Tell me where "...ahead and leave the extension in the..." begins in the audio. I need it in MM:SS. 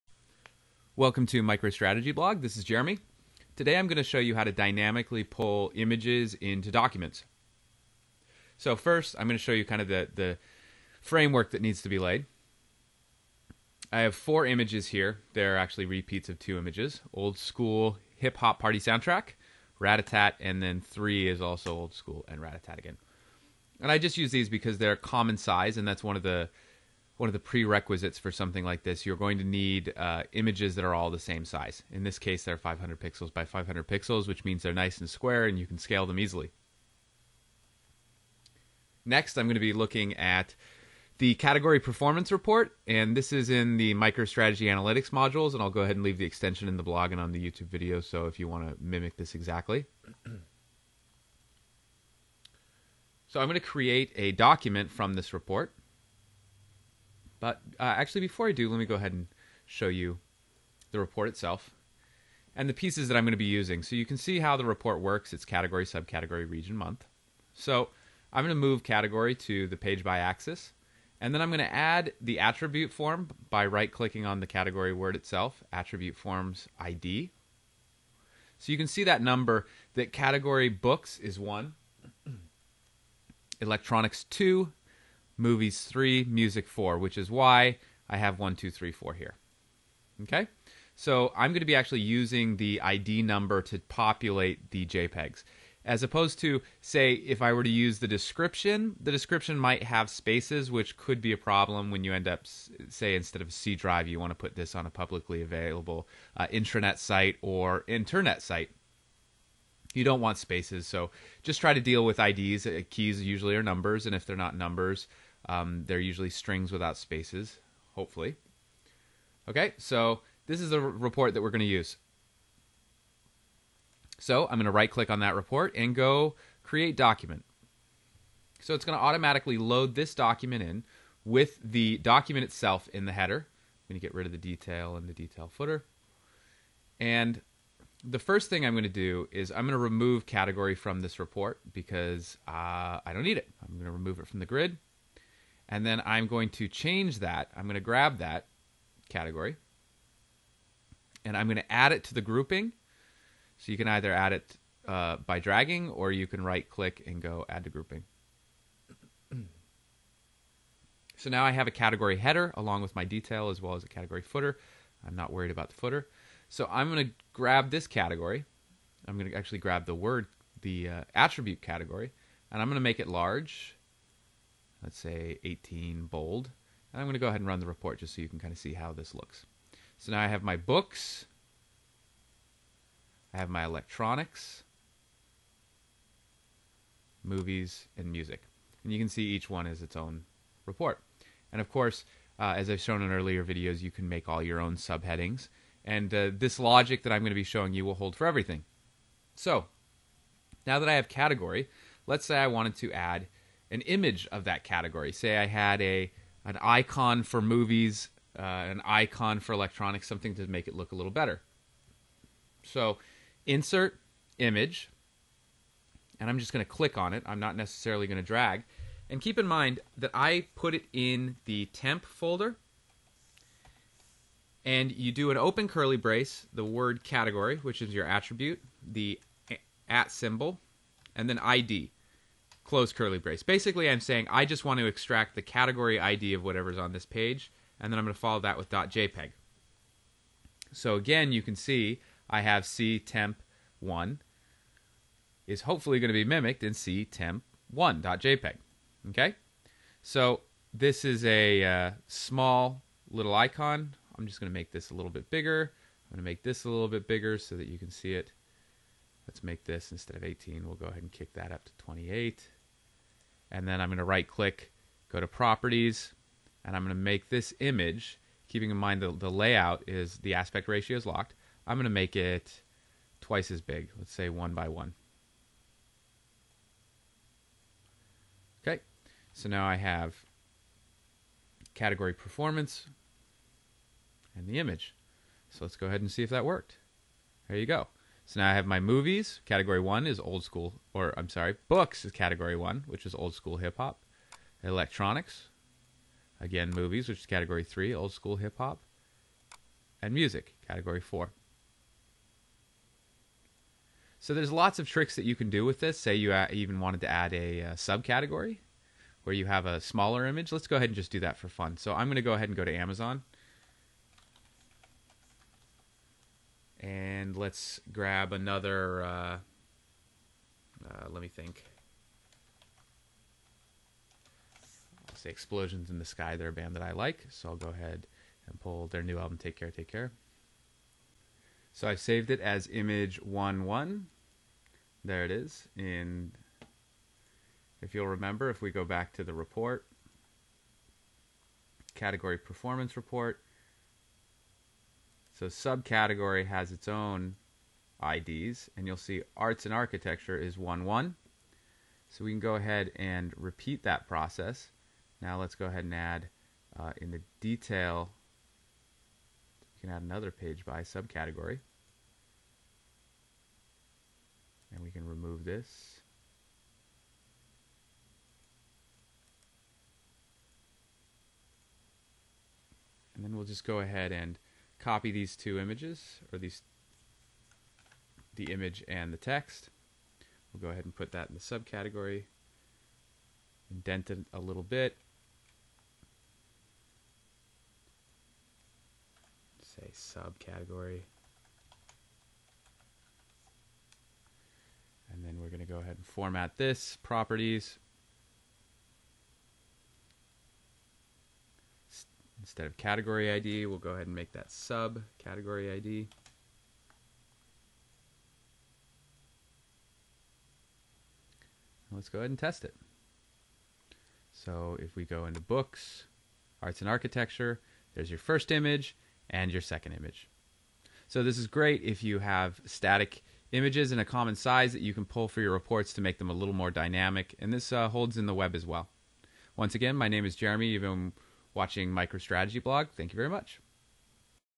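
00:45.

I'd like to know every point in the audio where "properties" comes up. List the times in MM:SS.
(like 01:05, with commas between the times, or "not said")
04:25, 06:37.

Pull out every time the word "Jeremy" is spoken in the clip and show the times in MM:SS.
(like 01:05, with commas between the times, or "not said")
00:02, 07:10.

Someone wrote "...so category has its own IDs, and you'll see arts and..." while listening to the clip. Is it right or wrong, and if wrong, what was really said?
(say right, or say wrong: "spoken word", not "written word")
wrong: "subcategory", not "category".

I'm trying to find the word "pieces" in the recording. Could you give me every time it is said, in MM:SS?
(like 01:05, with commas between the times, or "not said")
01:02.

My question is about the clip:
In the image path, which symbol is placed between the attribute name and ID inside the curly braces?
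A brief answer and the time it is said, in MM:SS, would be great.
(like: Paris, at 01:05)
at symbol, at 03:48.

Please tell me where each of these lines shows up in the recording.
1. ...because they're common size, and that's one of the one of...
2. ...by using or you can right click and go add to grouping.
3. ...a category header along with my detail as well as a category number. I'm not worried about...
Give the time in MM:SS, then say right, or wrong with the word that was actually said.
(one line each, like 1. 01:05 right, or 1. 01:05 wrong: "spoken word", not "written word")
1. 00:24 right
2. 02:35 wrong: "dragging", not "using"
3. 02:41 wrong: "footer", not "number".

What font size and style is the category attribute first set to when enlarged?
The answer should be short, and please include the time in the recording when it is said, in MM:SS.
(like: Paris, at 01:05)
18 bold, at 02:55.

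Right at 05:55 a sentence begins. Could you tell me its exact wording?
Now let's go ahead and add uh, in the detail, we can add another page by subcategory.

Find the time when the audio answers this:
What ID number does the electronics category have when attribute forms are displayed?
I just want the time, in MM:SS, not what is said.
01:23.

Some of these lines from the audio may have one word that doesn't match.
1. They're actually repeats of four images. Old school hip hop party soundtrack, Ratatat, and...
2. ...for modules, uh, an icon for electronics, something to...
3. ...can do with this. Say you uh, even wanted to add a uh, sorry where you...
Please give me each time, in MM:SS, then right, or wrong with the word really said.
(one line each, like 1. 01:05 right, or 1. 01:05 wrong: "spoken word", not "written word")
1. 00:15 wrong: "two", not "four"
2. 03:27 wrong: "movies", not "modules"
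3. 05:05 wrong: "subcategory", not "sorry".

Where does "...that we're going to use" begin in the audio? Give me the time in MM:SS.
02:01.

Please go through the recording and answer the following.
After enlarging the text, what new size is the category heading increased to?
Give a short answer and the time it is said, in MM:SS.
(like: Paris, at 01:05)
28, at 04:21.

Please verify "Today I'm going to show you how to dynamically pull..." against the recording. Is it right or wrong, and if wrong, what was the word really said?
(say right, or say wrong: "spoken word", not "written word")
right.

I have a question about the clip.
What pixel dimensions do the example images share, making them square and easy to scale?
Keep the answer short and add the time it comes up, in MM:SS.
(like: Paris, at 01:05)
500 by 500 pixels, at 00:32.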